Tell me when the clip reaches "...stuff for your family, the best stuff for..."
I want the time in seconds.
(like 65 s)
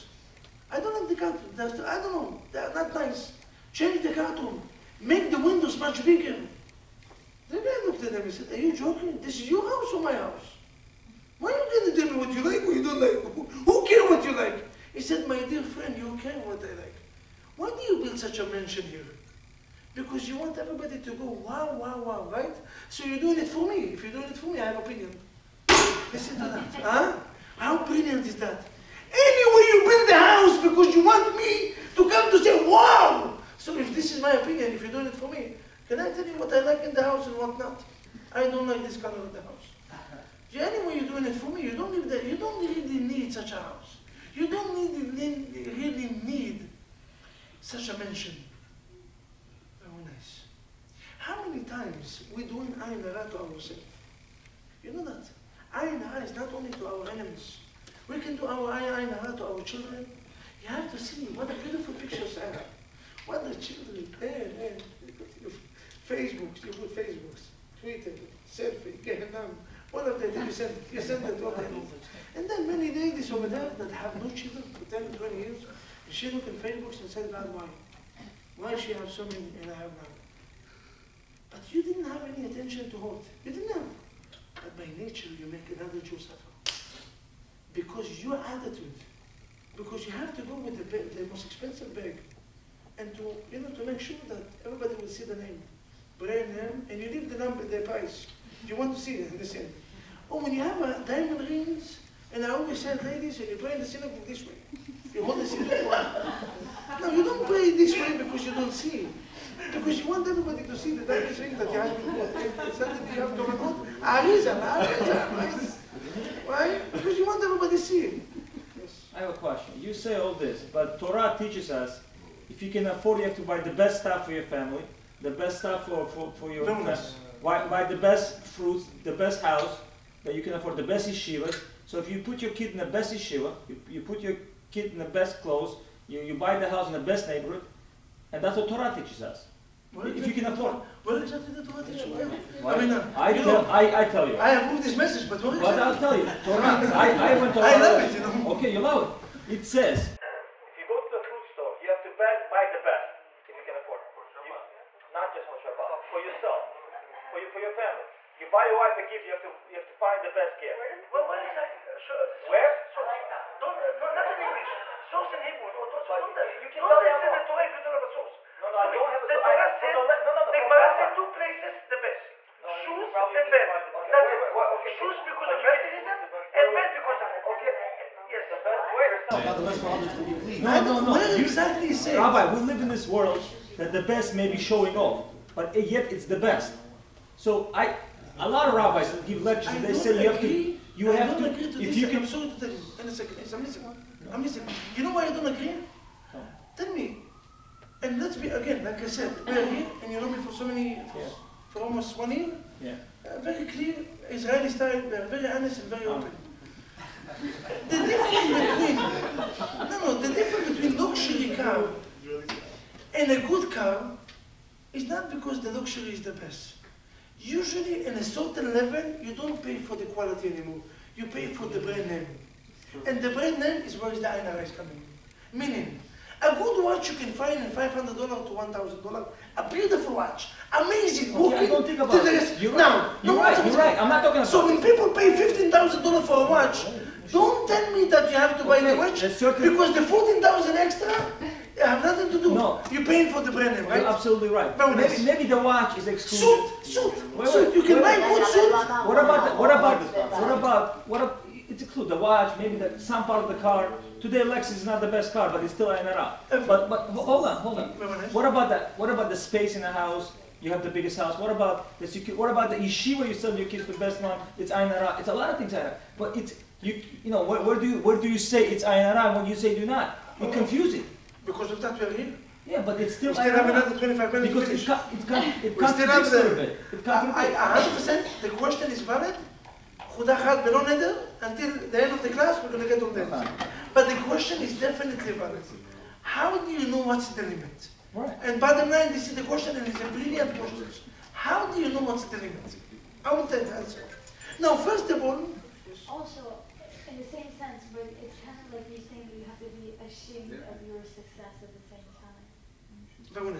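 124 s.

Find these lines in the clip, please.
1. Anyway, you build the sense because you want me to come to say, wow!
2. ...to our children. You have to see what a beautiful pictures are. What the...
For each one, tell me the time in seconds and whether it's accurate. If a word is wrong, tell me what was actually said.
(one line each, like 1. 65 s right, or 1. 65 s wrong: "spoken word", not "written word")
1. 29 s wrong: "house", not "sense"
2. 59 s right.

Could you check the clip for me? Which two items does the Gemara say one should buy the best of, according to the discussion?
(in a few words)
Shoes and bed.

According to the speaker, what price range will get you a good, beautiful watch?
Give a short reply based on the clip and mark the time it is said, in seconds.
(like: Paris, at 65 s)
$500 to $1,000, at 227 s.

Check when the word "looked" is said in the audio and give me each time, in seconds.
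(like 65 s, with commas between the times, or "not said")
7 s, 76 s.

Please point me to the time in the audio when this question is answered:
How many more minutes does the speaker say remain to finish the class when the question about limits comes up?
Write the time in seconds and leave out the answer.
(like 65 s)
273 s.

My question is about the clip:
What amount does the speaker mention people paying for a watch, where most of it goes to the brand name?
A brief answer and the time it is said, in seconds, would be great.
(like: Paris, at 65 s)
$15,000, at 235 s.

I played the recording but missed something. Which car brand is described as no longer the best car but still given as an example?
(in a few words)
Lexus.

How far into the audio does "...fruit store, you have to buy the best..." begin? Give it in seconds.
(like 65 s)
151 s.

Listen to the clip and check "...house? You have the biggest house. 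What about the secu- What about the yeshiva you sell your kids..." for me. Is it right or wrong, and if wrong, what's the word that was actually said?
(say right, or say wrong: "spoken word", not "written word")
right.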